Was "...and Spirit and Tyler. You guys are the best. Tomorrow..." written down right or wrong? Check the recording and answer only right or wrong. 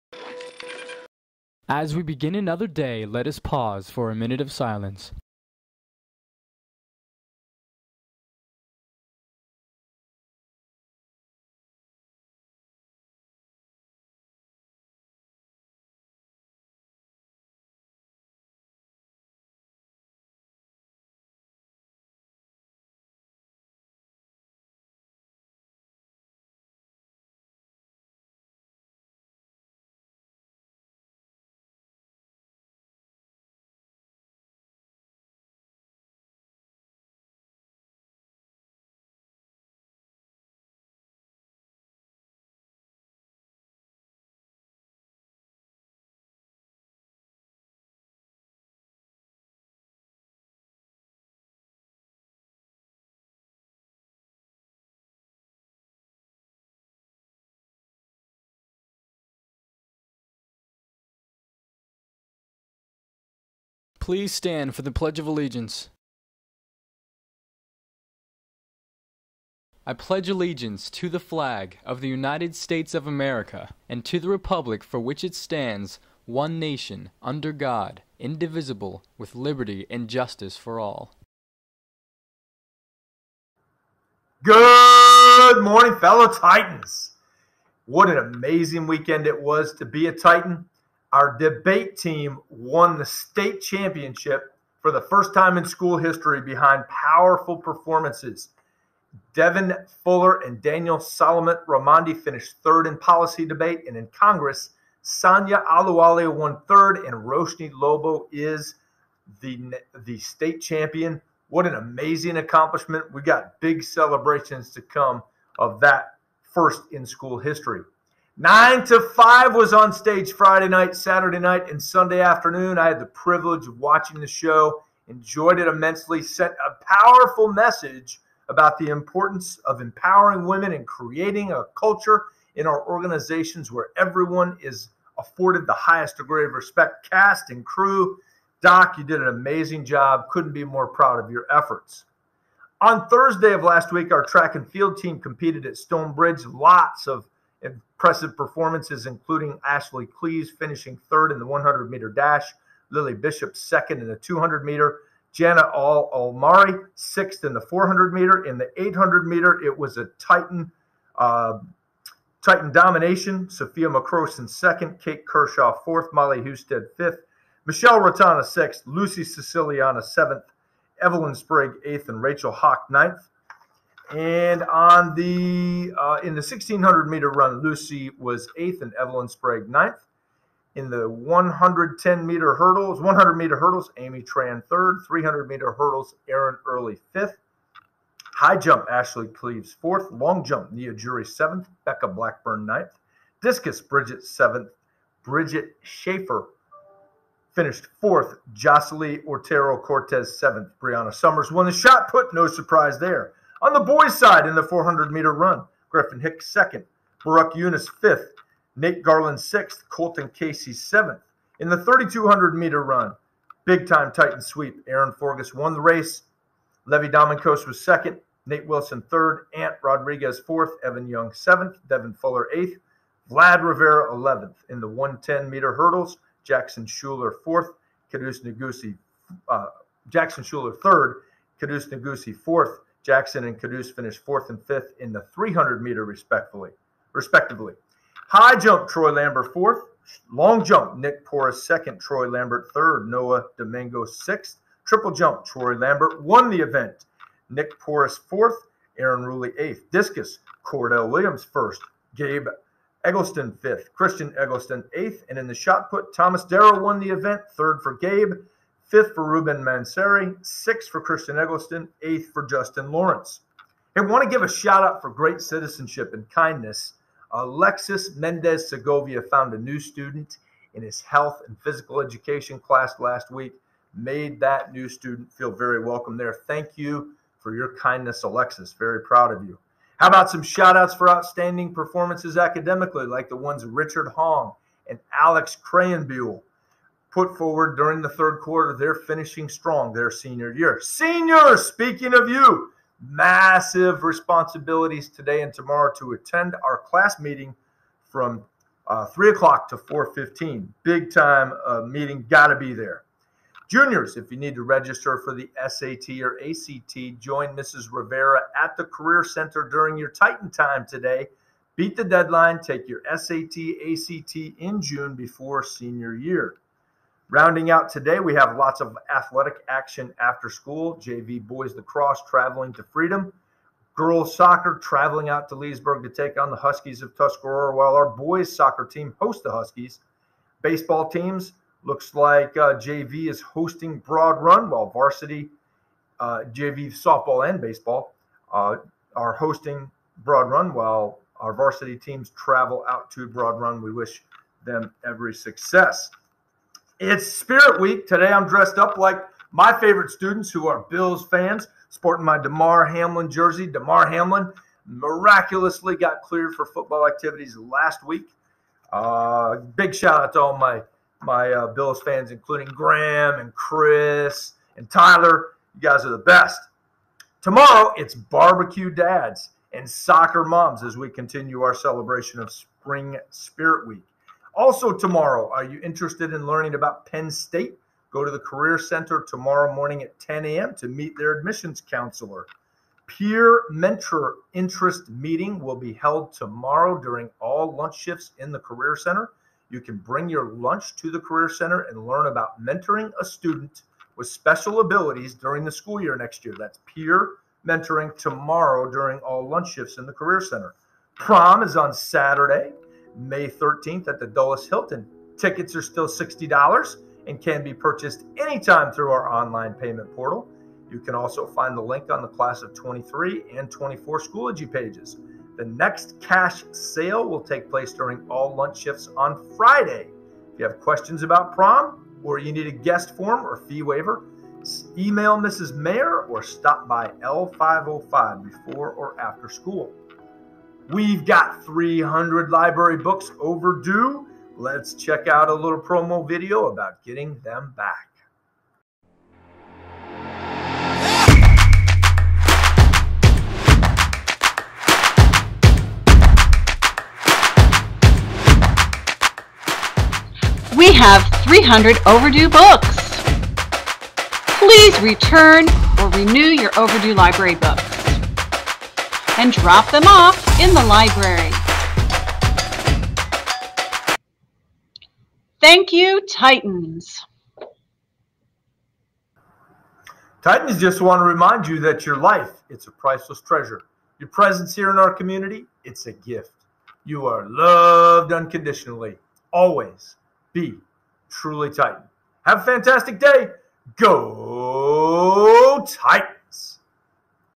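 wrong.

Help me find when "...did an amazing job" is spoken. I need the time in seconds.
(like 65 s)
139 s.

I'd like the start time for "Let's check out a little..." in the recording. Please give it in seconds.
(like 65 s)
434 s.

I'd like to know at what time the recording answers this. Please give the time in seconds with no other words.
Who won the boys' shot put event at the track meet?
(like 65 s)
256 s.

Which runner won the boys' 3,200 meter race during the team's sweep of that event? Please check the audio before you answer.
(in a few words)
Aaron Forgas.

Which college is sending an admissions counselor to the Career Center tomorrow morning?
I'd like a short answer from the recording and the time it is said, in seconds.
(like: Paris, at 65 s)
Penn State, at 377 s.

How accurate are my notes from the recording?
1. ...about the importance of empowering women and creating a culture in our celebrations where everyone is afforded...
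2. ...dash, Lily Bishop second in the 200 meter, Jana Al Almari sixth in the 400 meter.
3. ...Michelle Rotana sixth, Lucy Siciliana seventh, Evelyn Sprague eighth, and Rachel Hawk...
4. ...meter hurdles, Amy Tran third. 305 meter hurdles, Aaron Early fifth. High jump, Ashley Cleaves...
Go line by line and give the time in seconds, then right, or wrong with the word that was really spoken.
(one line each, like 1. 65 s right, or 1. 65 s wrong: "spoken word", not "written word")
1. 128 s wrong: "organizations", not "celebrations"
2. 152 s right
3. 167 s right
4. 183 s wrong: "300", not "305".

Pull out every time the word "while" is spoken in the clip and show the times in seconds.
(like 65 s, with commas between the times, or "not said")
327 s, 334 s, 340 s.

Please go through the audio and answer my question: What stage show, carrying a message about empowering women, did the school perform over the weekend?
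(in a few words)
9 to 5.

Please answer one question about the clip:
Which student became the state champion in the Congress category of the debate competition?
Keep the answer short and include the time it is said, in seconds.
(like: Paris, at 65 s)
Roshni Lobo, at 107 s.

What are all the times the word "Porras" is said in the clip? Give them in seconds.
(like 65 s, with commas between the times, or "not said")
241 s, 247 s.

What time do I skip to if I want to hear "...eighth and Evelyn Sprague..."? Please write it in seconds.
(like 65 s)
178 s.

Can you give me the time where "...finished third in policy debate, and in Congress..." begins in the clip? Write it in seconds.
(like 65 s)
102 s.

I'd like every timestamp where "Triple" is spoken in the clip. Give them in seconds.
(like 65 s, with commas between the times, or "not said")
244 s.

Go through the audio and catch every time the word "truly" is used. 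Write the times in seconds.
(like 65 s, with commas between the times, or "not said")
481 s.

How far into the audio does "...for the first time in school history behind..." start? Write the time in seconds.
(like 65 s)
94 s.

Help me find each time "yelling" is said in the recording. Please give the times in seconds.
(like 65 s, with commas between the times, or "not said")
not said.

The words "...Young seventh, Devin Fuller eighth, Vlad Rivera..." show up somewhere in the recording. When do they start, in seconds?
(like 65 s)
221 s.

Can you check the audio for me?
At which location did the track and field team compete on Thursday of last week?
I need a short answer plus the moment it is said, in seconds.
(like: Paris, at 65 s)
Stonebridge, at 145 s.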